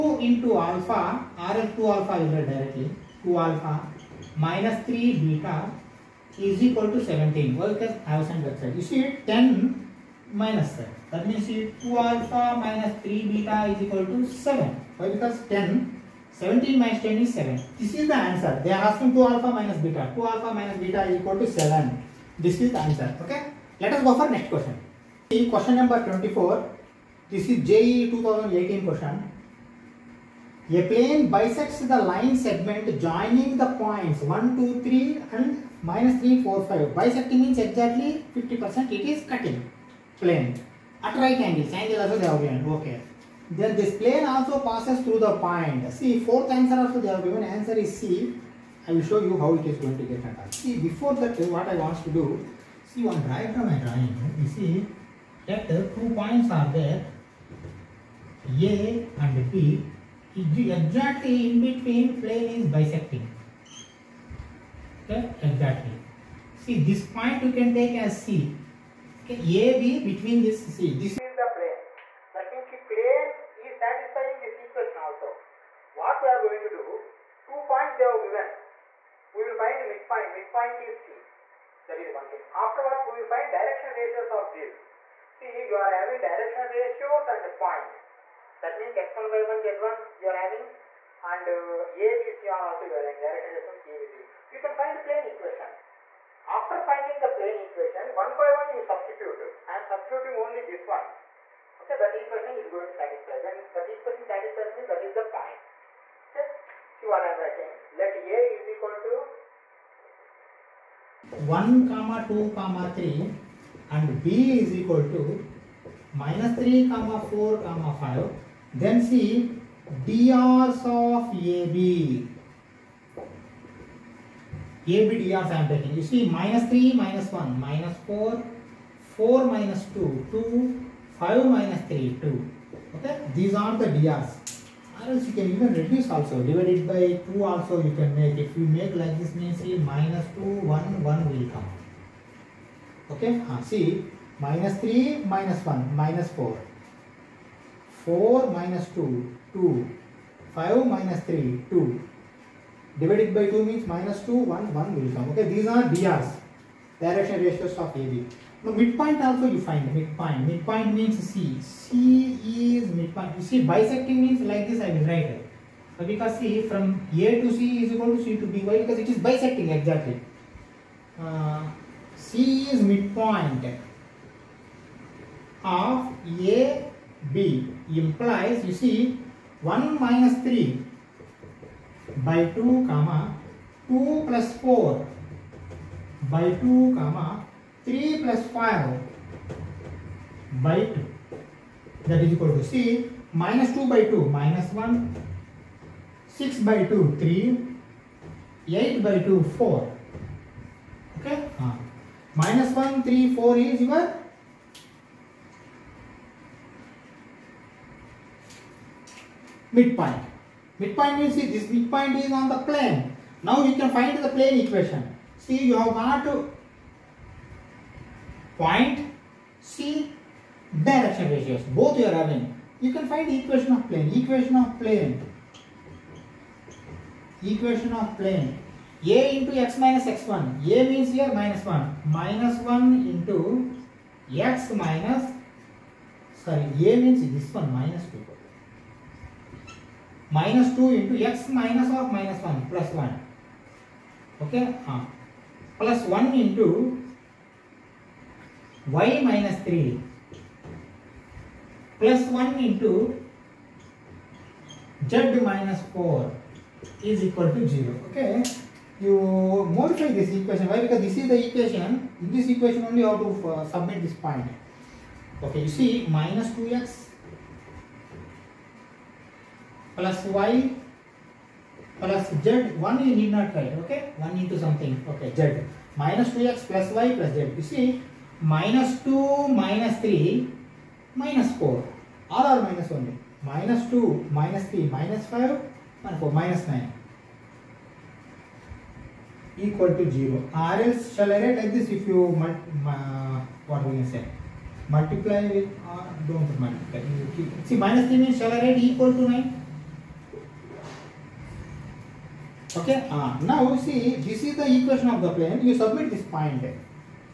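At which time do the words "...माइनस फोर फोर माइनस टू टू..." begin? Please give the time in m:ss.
2:07.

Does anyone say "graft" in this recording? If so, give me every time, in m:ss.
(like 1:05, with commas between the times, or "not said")
not said.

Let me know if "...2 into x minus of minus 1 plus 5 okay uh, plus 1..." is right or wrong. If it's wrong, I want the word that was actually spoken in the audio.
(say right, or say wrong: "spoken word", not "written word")
wrong: "1", not "5".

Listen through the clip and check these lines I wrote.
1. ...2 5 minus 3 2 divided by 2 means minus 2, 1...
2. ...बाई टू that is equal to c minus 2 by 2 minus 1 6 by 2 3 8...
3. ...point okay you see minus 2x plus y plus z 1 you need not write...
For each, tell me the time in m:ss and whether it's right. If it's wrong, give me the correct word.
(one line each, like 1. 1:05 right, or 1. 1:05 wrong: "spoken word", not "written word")
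1. 2:29 right
2. 3:10 right
3. 4:24 right.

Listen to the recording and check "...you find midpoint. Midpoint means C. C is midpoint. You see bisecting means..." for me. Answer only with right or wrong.
right.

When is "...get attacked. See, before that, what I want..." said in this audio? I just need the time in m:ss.
0:50.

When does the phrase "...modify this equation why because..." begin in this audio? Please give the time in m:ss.
4:19.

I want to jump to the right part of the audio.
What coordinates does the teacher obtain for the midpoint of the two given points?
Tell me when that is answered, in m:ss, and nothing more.
3:22.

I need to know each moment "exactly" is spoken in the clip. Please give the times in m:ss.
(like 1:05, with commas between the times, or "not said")
0:37, 1:00, 1:05, 2:49.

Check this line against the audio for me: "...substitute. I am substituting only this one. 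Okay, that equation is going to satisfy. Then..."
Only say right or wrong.
right.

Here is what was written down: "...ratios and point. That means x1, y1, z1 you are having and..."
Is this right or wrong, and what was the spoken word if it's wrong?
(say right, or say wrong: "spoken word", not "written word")
right.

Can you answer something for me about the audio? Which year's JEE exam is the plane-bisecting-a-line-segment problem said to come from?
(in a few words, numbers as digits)
2018.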